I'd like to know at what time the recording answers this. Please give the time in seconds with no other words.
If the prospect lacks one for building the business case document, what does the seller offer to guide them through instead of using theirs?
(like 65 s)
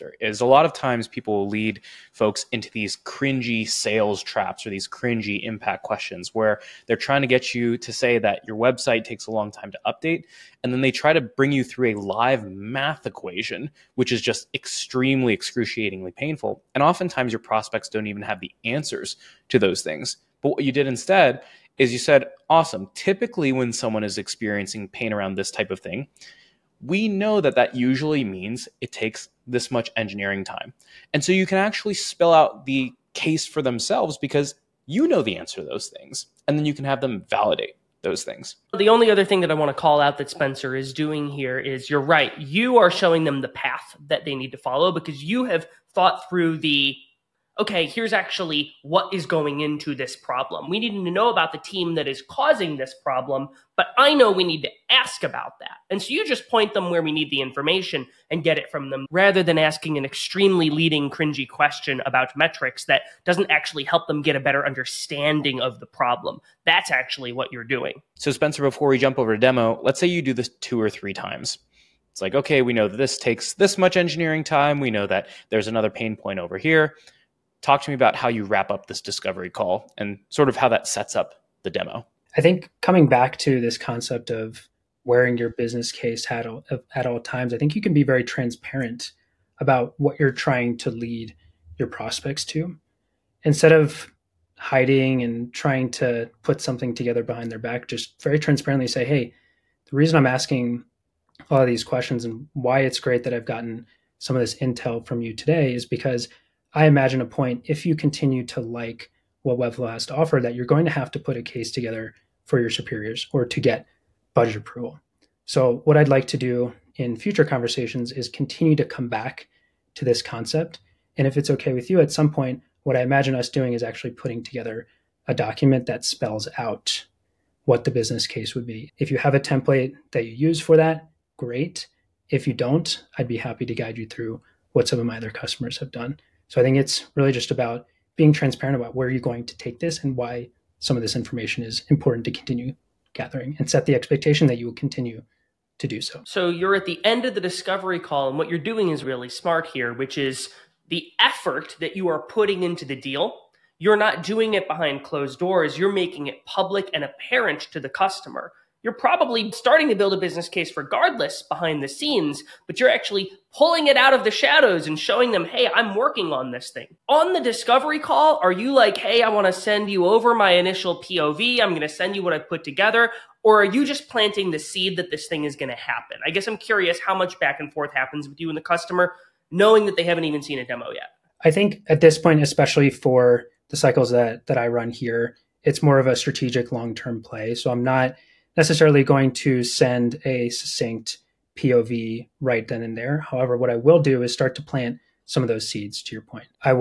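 129 s.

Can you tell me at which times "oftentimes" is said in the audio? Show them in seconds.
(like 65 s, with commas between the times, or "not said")
16 s.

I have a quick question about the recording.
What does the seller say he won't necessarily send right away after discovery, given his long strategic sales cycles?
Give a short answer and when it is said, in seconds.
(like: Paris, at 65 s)
A succinct POV, at 190 s.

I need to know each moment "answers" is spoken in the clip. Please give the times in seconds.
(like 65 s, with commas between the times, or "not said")
18 s, 35 s.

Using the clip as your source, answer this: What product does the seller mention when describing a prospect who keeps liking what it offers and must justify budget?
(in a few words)
Webflow.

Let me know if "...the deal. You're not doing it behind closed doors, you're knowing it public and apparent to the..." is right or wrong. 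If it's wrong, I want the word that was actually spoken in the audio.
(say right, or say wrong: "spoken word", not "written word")
wrong: "making", not "knowing".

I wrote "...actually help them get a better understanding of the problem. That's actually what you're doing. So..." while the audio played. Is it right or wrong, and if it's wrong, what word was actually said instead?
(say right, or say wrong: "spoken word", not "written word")
right.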